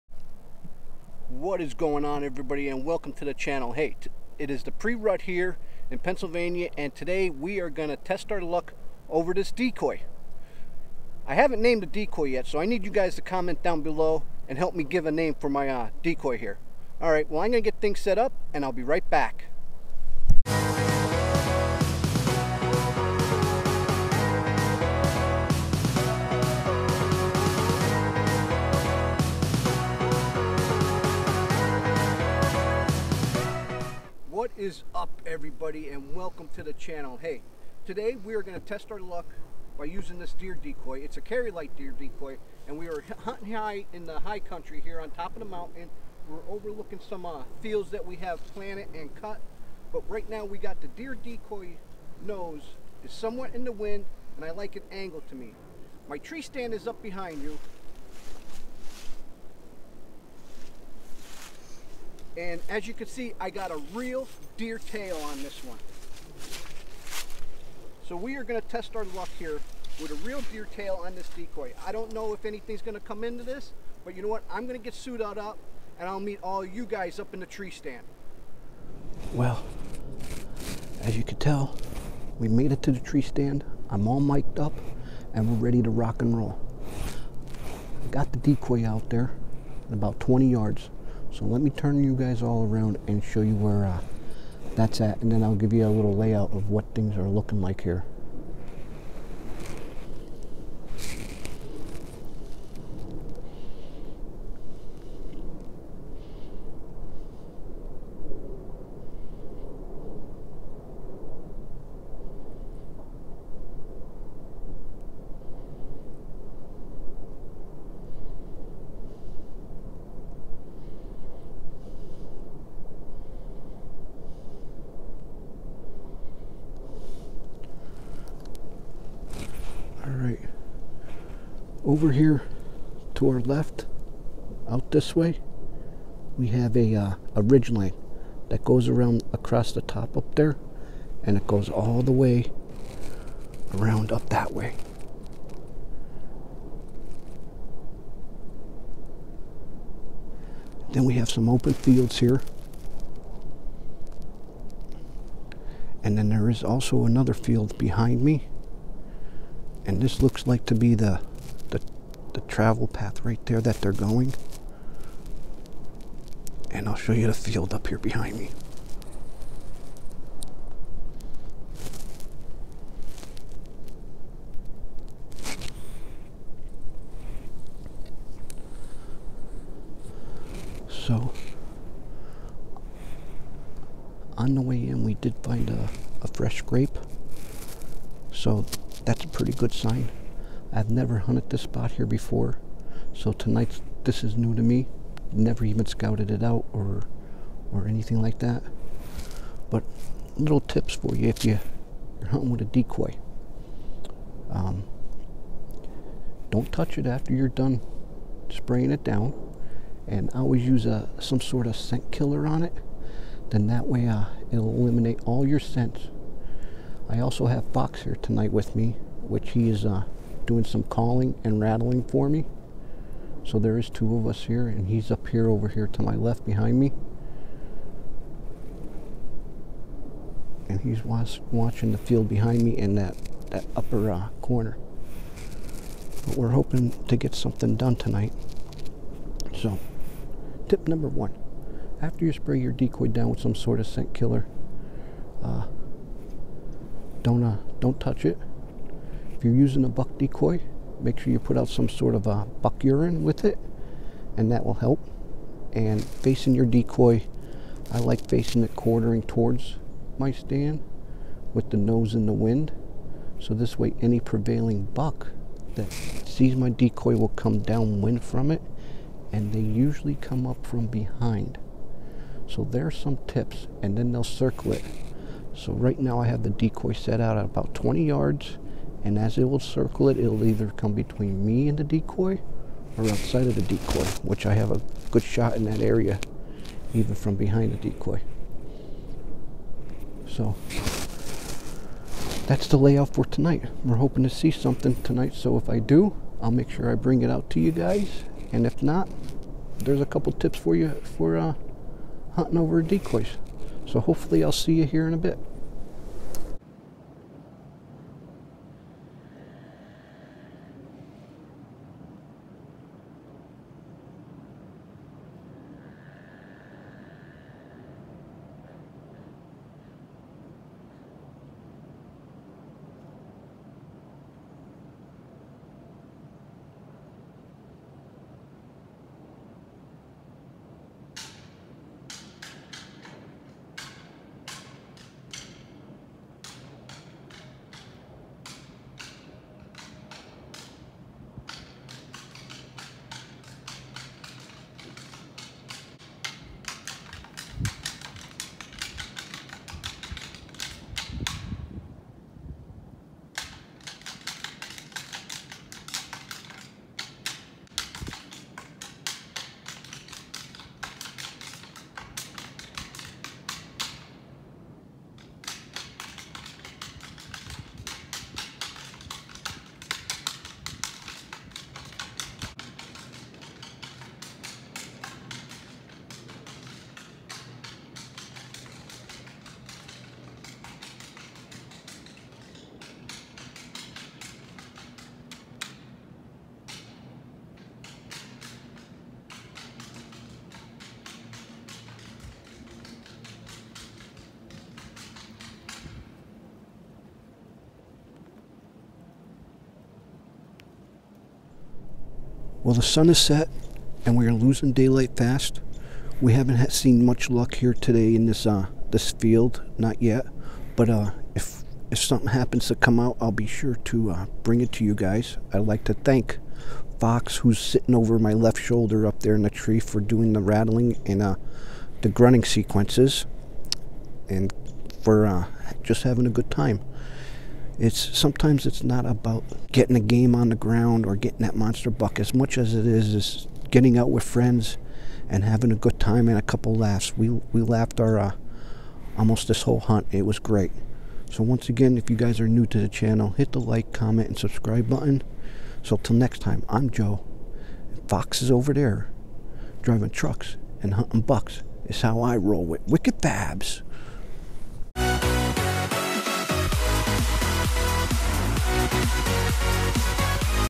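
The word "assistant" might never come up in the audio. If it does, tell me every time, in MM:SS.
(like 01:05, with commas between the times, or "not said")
not said.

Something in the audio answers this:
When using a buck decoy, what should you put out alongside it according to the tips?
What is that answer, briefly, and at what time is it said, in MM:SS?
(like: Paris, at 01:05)
buck urine, at 04:12.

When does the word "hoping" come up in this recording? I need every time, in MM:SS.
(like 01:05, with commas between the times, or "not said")
03:56, 04:53.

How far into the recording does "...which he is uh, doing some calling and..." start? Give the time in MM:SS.
03:39.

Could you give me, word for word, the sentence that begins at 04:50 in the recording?
So that's the layout for tonight.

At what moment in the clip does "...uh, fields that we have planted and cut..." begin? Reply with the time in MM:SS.
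00:47.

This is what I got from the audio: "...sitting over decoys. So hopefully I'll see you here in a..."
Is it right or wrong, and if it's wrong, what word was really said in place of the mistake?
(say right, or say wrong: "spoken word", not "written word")
wrong: "hunting", not "sitting".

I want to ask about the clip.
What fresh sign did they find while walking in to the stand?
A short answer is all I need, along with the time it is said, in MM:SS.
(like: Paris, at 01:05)
a fresh grape, at 03:06.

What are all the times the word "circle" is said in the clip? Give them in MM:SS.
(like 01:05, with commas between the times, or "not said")
04:34, 04:39.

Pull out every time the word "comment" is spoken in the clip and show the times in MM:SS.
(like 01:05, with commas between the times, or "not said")
00:13, 07:23.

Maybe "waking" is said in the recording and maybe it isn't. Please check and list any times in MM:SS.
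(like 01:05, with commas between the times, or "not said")
not said.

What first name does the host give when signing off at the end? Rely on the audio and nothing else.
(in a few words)
Joe.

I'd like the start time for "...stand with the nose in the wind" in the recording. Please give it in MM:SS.
04:20.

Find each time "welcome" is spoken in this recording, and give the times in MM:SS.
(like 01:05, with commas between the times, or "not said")
00:02, 00:36.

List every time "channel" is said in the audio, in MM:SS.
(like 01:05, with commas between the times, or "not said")
00:03, 00:36, 07:22.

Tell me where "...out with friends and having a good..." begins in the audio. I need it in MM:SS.
07:13.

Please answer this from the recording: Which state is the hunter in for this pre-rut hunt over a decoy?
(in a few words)
Pennsylvania.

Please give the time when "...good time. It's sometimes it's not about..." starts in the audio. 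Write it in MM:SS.
07:06.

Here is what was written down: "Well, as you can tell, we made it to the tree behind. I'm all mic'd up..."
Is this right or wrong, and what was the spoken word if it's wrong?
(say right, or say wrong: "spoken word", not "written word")
wrong: "stand", not "behind".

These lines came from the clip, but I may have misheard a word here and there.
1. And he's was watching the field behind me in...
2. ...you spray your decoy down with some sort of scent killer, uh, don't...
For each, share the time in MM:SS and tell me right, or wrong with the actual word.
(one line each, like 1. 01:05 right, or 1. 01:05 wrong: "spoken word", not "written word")
1. 03:50 right
2. 04:02 right.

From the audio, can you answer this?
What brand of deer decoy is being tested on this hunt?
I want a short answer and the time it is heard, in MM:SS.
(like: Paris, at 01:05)
Carry-Lite, at 00:41.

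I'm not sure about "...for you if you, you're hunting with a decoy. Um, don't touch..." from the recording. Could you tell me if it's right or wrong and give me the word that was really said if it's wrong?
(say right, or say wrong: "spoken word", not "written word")
right.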